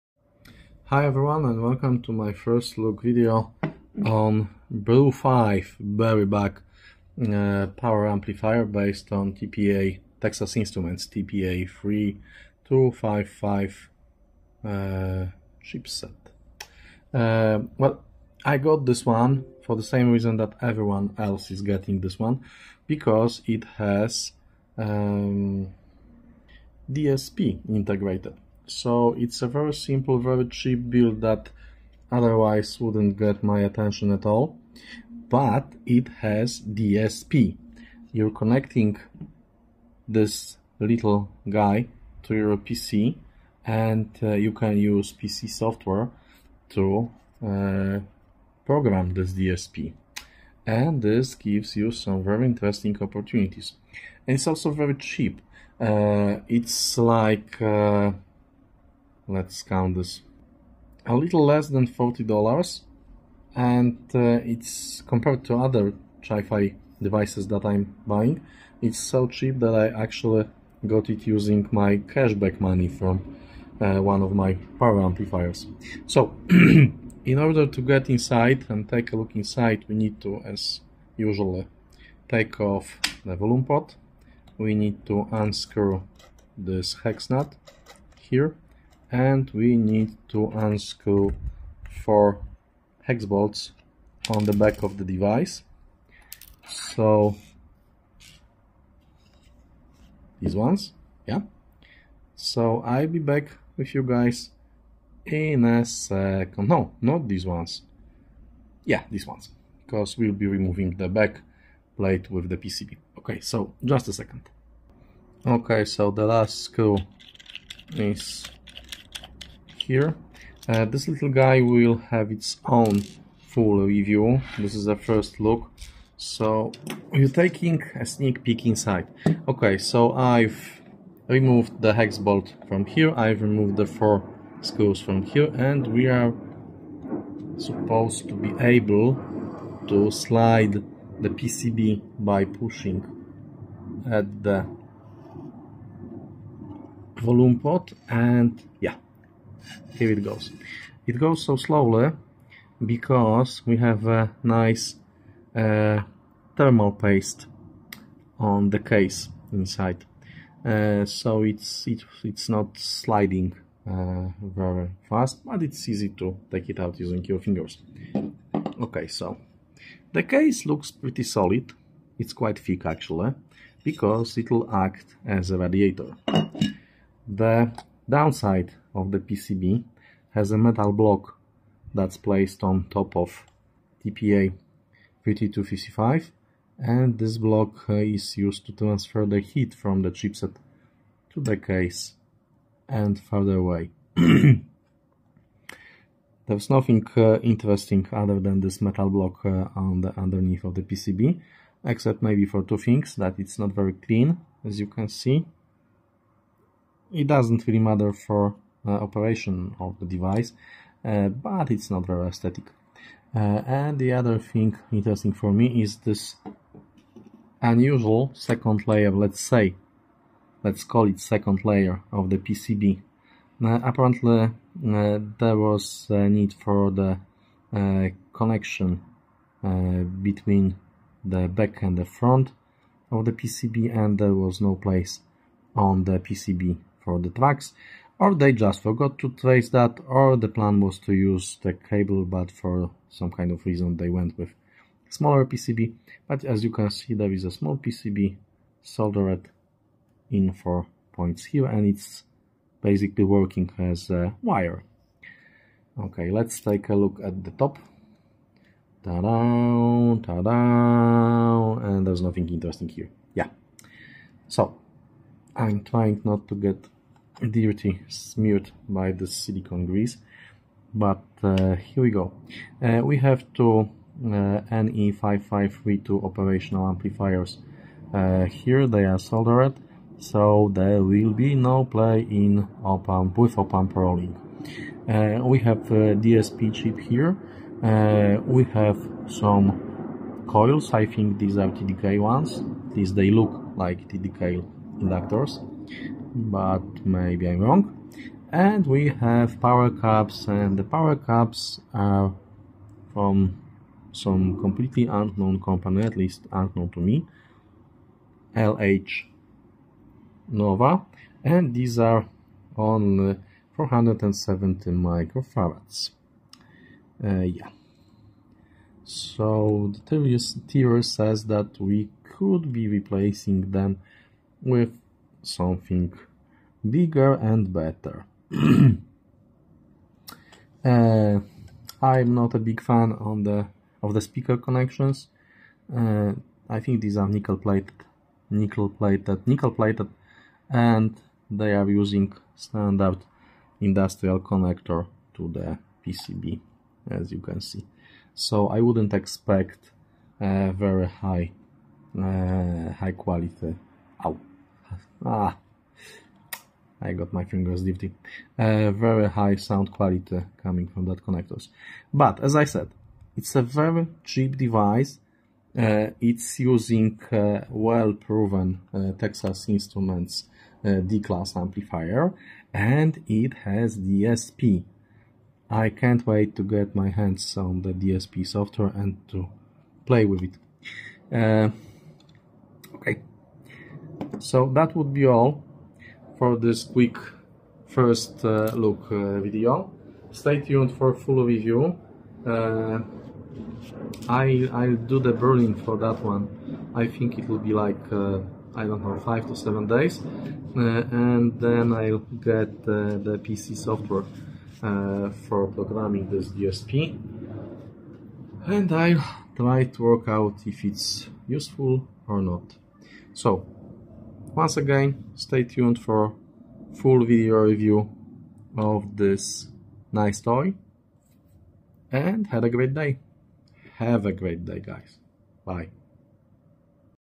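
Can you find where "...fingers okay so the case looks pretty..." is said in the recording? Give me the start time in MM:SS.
02:47.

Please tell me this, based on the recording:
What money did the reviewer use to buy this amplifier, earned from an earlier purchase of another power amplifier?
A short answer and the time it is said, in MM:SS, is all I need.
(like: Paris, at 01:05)
cashback money, at 01:11.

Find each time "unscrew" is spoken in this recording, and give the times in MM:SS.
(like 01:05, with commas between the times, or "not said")
01:25, 01:30.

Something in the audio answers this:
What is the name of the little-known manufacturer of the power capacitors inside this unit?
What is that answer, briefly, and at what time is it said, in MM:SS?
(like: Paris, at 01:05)
LH Nova, at 05:08.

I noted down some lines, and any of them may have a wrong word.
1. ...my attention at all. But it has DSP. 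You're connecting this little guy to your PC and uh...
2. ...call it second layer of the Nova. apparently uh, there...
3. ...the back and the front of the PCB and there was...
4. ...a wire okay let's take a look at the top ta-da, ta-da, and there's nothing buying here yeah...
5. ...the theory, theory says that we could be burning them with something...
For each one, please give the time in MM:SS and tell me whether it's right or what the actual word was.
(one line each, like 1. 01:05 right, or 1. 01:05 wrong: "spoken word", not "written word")
1. 00:33 right
2. 03:40 wrong: "PCB", not "Nova"
3. 03:51 right
4. 04:14 wrong: "interesting", not "buying"
5. 05:19 wrong: "replacing", not "burning".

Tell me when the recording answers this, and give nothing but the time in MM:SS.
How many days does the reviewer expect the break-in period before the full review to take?
06:39.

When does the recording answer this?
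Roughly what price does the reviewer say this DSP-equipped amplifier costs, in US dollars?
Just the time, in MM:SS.
01:01.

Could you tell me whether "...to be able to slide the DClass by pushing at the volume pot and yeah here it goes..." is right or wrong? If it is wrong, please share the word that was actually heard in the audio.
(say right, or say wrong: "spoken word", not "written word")
wrong: "PCB", not "DClass".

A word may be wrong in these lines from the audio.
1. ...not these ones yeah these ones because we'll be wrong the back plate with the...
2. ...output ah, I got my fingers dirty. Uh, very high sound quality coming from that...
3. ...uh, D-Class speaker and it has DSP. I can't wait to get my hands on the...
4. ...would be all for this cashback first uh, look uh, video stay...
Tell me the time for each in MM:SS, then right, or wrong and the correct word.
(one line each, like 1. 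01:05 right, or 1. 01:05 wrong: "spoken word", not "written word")
1. 01:47 wrong: "removing", not "wrong"
2. 05:54 right
3. 06:10 wrong: "amplifier", not "speaker"
4. 06:24 wrong: "quick", not "cashback".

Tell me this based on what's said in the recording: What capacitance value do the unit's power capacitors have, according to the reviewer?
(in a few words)
470 microfarads.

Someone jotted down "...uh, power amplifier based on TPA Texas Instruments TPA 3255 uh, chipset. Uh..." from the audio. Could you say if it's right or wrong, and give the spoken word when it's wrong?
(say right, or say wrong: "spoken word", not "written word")
right.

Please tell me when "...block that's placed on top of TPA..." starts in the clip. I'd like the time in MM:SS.
03:00.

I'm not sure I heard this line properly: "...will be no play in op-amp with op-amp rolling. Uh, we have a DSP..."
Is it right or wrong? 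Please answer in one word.
right.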